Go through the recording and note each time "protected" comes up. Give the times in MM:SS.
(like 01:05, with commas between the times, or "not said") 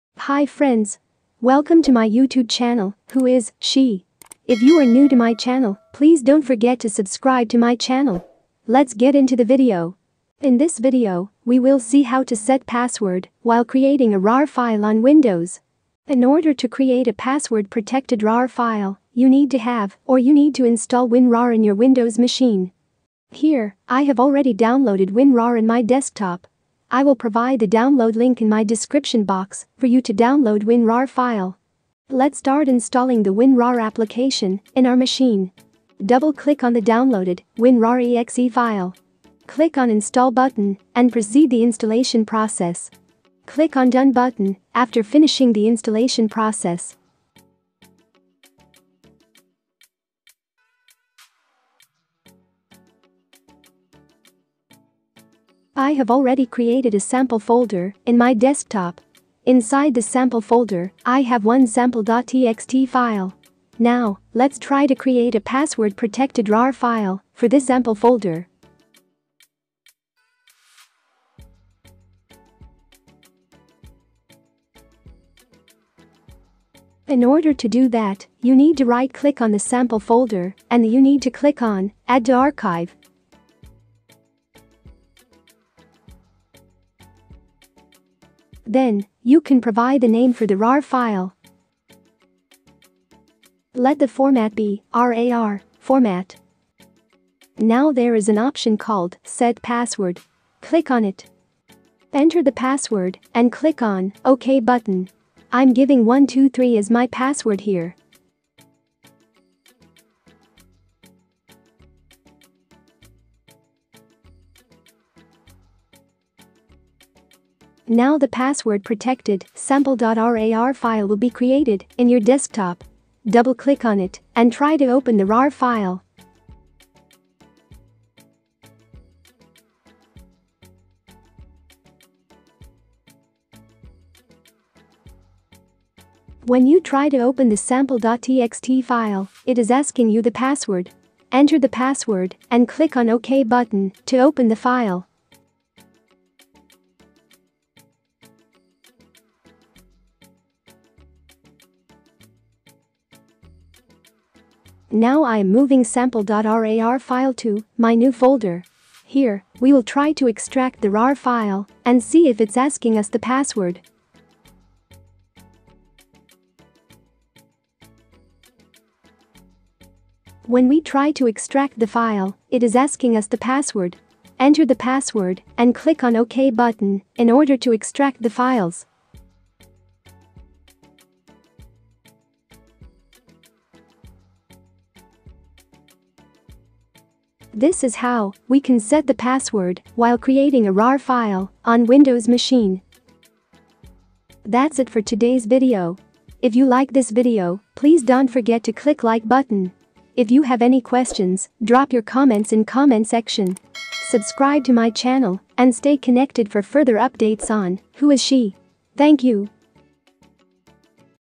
00:17, 01:05, 01:58.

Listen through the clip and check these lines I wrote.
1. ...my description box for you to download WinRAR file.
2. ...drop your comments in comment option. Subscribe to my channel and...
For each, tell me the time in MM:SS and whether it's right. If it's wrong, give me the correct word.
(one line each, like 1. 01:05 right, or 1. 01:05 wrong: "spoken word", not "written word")
1. 00:28 right
2. 03:21 wrong: "section", not "option".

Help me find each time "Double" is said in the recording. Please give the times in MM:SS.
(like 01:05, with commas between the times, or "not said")
00:36, 02:03.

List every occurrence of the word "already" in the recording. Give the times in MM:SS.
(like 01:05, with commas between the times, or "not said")
00:24, 00:56.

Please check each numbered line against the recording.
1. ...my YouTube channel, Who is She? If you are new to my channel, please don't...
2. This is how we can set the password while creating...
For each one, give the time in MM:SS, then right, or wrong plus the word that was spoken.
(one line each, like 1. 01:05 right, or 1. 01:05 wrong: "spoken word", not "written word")
1. 00:01 right
2. 03:07 right.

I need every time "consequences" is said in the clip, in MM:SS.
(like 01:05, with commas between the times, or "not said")
not said.